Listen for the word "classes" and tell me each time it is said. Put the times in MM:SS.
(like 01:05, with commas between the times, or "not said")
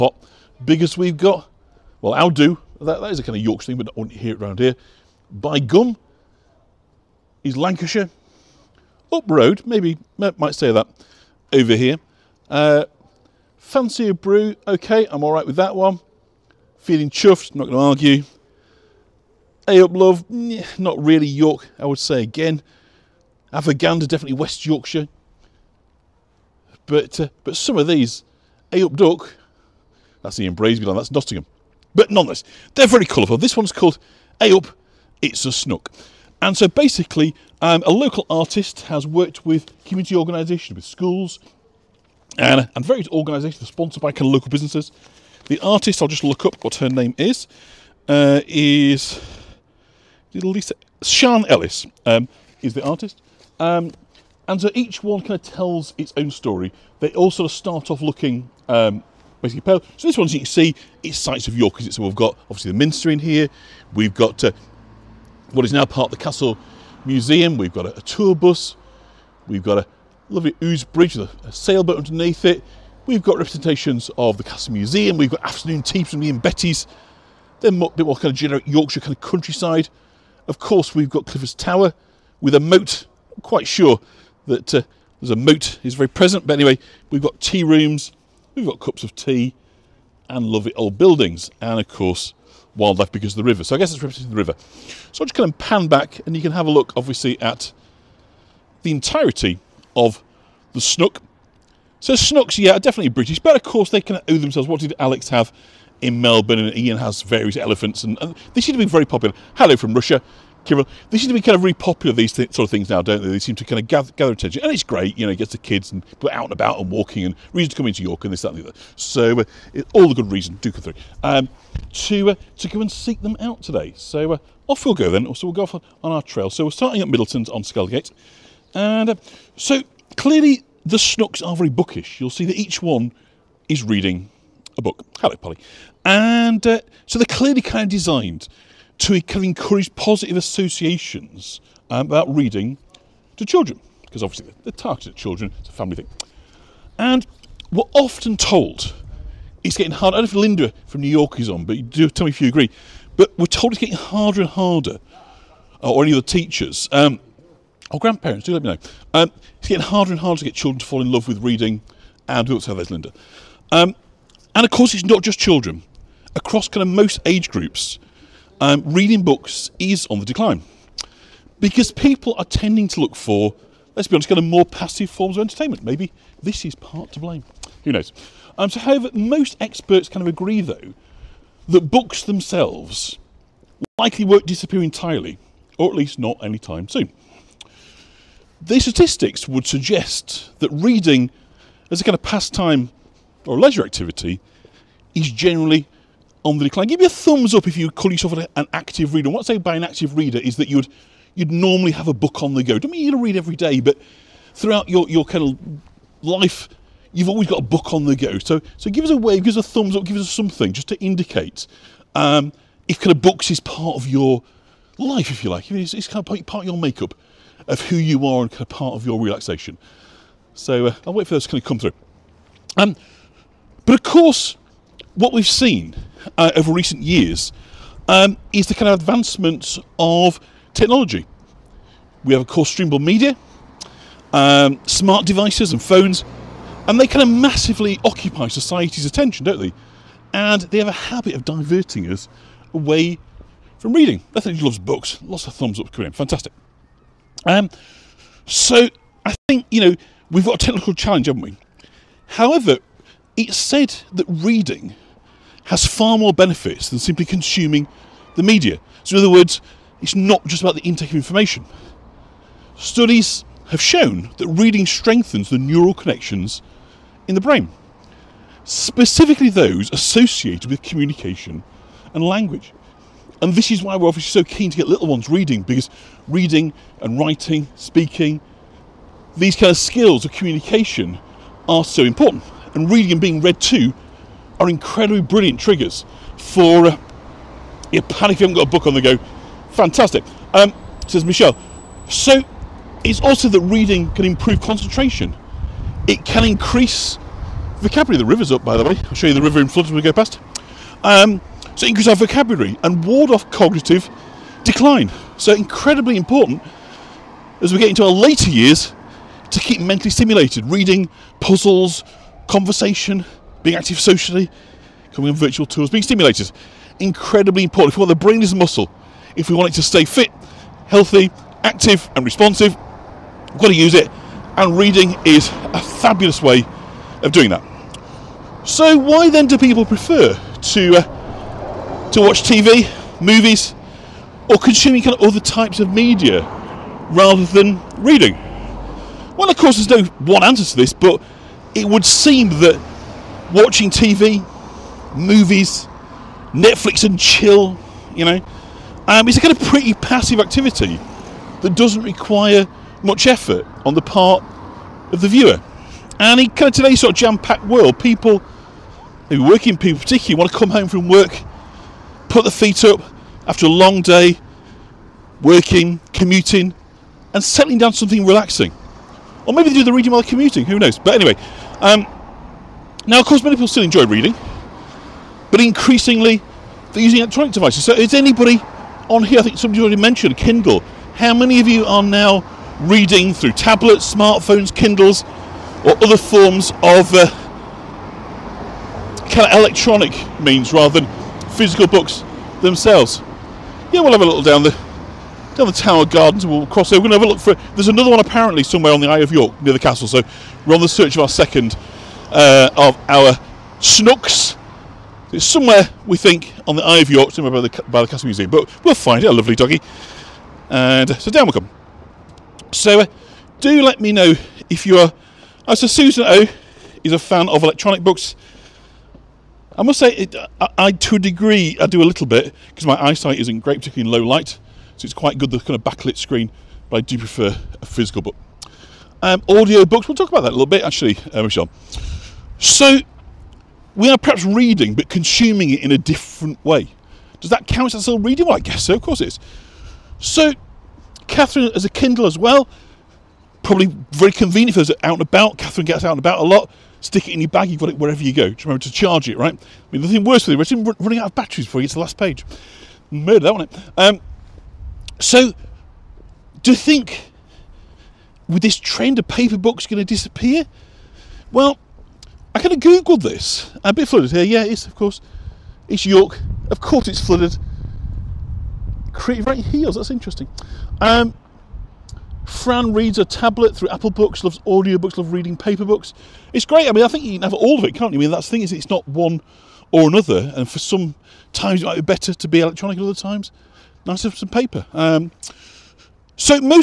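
not said.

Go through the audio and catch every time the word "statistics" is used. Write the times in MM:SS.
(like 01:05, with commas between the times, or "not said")
03:08.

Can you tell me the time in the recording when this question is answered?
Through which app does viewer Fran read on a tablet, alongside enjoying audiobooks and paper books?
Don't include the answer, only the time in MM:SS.
07:53.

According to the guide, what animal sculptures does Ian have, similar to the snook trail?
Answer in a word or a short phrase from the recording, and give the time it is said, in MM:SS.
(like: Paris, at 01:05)
Elephants, at 01:47.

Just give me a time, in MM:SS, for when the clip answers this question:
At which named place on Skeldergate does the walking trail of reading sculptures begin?
02:07.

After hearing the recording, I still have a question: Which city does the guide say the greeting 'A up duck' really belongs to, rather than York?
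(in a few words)
Nottingham.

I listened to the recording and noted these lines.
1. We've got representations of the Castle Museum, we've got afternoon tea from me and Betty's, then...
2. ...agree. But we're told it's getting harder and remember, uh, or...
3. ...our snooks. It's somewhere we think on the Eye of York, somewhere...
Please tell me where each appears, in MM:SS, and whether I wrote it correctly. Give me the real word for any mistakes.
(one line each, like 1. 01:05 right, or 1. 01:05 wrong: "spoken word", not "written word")
1. 01:13 right
2. 02:32 wrong: "harder", not "remember"
3. 06:43 right.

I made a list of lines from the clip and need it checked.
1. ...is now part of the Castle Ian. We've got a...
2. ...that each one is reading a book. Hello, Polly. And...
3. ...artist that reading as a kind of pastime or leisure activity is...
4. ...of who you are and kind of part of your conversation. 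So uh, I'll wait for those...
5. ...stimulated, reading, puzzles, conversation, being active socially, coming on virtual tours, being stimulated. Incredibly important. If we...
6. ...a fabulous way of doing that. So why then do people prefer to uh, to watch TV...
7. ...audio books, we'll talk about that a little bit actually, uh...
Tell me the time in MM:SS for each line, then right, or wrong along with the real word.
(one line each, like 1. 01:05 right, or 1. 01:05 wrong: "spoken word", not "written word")
1. 01:05 wrong: "Museum", not "Ian"
2. 02:12 right
3. 03:09 wrong: "suggest", not "artist"
4. 03:37 wrong: "relaxation", not "conversation"
5. 05:10 right
6. 05:25 right
7. 07:09 right.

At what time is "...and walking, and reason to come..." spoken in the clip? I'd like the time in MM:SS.
01:56.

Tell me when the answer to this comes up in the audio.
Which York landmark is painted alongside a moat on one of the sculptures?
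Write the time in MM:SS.
01:21.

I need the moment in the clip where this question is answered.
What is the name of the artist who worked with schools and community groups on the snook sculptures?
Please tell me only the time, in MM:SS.
00:50.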